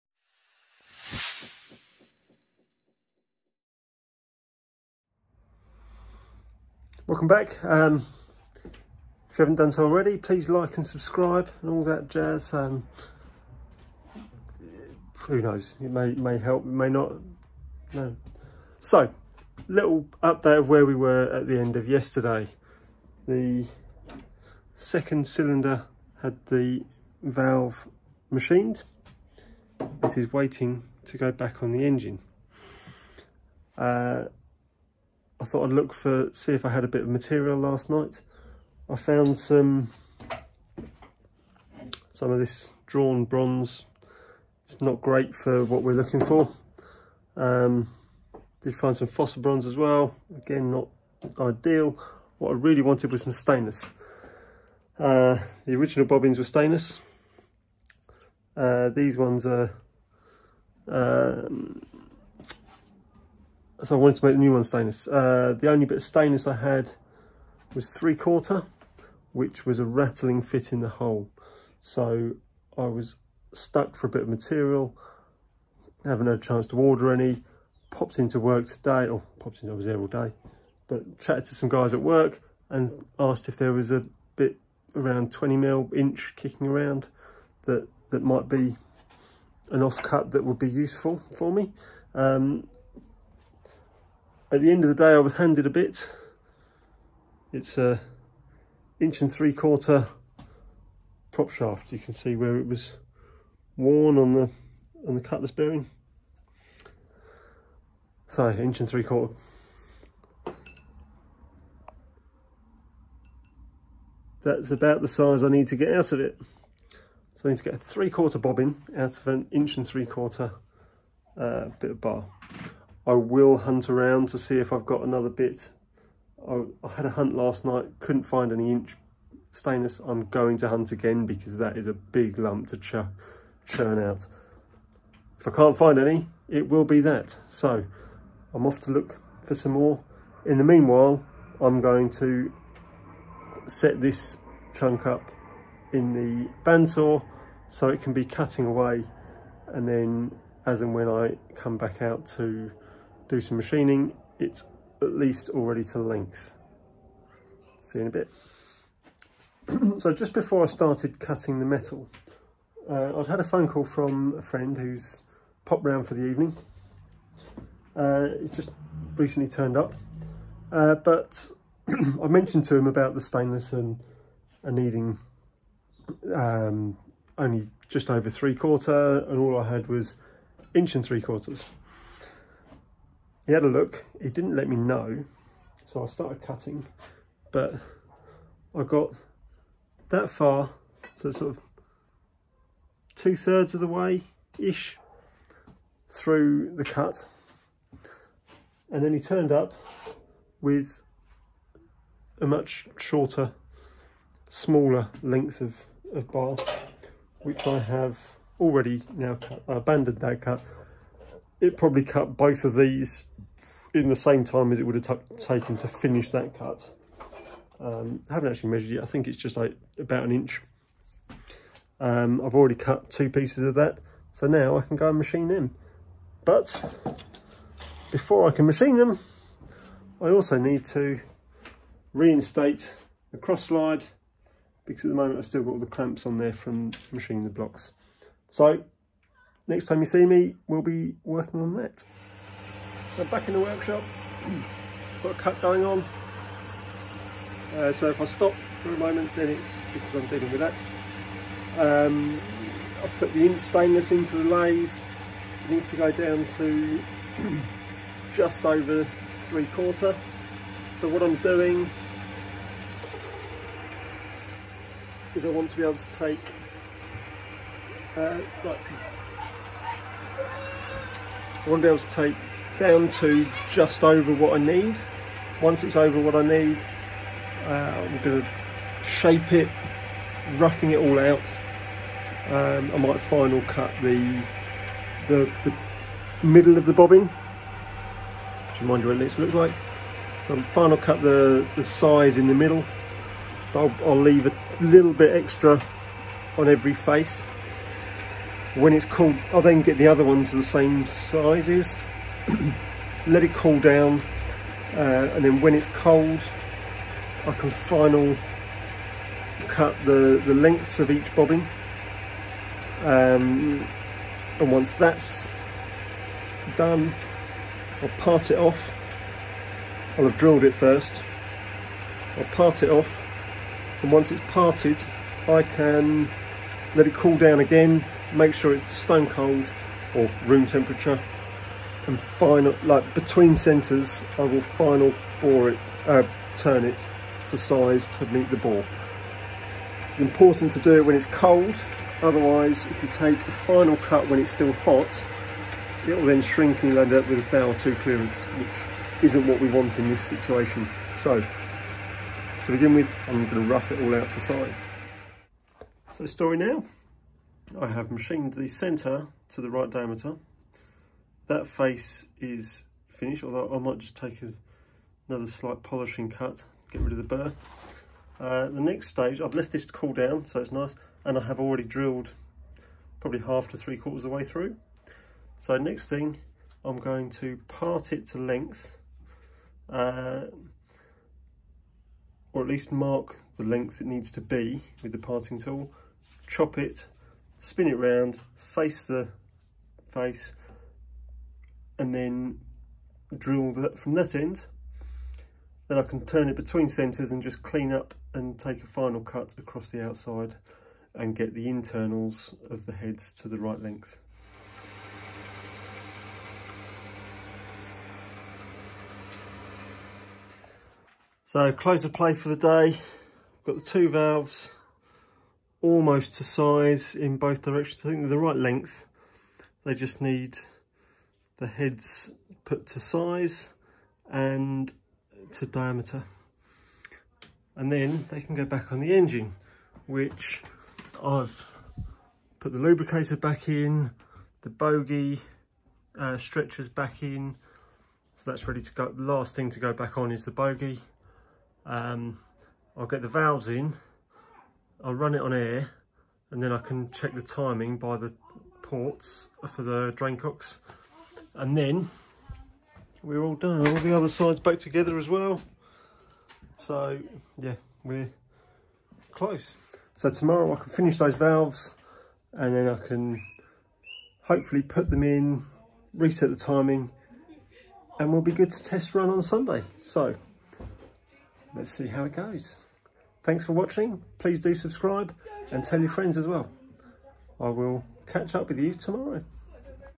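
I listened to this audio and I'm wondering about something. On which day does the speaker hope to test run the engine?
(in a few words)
Sunday.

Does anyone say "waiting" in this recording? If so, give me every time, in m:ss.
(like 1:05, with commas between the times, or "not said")
0:30.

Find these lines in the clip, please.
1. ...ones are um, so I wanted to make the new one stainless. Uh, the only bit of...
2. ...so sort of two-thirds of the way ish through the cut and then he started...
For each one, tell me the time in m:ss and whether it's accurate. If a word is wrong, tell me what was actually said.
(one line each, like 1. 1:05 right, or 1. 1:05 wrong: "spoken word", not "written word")
1. 0:59 right
2. 3:11 wrong: "turned", not "started".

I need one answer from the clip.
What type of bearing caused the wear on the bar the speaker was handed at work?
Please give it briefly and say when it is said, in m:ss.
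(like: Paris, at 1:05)
cutlass bearing, at 1:45.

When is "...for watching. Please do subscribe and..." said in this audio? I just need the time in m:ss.
7:53.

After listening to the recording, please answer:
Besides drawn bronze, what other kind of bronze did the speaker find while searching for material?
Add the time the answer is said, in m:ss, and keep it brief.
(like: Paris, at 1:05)
phosphor bronze, at 0:49.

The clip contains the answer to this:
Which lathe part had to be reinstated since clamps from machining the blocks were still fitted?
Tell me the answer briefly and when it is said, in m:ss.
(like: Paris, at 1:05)
cross slide, at 3:53.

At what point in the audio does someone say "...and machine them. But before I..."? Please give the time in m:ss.
3:45.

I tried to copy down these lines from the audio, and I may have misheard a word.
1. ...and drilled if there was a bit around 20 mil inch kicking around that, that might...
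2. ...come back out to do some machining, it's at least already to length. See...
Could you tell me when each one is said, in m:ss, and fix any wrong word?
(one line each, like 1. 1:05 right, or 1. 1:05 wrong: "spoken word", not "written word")
1. 1:22 wrong: "asked", not "drilled"
2. 2:31 right.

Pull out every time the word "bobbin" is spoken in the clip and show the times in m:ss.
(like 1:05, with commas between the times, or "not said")
0:56, 1:58, 4:46, 5:11.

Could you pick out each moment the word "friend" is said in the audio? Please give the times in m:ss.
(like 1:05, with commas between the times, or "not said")
2:44, 7:56.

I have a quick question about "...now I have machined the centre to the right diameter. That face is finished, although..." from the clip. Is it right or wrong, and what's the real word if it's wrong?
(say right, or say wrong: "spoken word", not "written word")
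right.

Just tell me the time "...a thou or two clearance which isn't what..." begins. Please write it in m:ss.
5:47.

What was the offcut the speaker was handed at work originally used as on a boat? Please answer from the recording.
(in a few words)
prop shaft.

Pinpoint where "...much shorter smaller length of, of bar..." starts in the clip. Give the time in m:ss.
3:22.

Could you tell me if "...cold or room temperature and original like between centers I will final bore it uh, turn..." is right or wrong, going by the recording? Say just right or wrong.
wrong.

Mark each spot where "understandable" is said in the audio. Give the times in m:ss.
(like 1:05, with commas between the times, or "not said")
not said.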